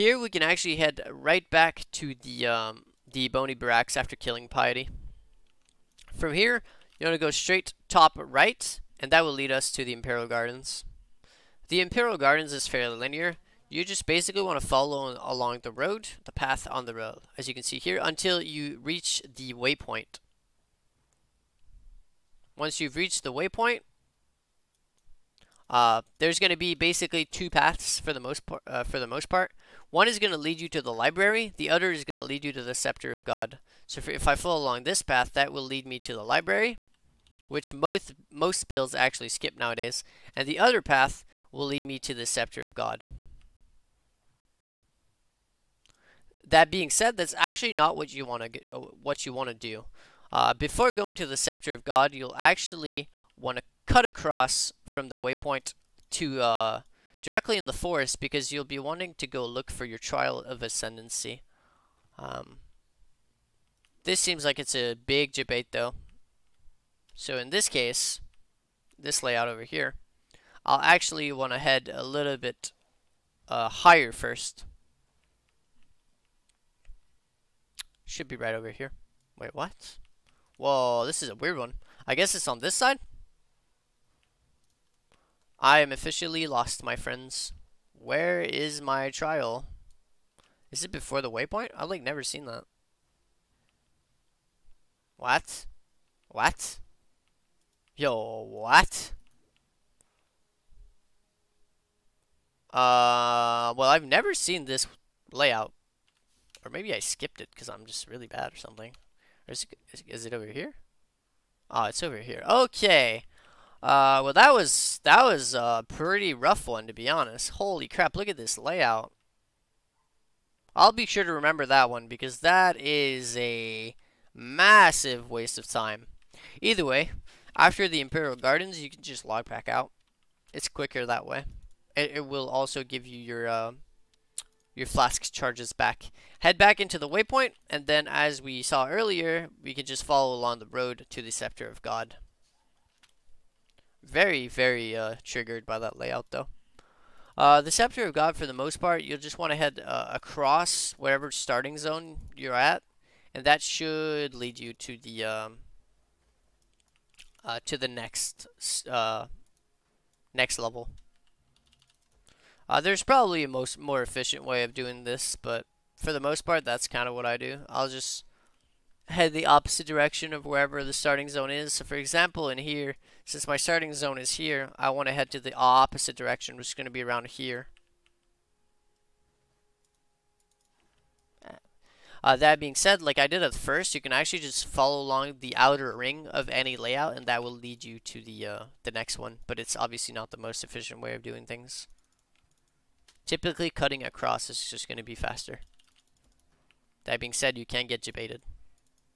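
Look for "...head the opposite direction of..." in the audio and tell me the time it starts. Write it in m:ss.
2:49.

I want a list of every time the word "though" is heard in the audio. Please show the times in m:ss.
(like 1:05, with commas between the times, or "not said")
1:05, 2:26.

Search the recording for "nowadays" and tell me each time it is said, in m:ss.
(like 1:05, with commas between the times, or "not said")
0:39.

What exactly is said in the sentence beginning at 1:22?
I guess it's on this side?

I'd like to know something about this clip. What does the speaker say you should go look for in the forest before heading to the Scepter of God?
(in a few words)
Trial of Ascendancy.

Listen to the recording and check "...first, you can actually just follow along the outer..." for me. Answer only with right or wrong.
right.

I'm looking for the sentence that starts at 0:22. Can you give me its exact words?
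Once you've reached the waypoint, uh, there's going to be basically two paths for the most part.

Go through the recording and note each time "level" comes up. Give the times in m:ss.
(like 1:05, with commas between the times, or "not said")
2:40.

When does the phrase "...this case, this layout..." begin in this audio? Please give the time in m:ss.
1:07.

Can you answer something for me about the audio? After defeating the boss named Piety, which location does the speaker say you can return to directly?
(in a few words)
Bony Barracks.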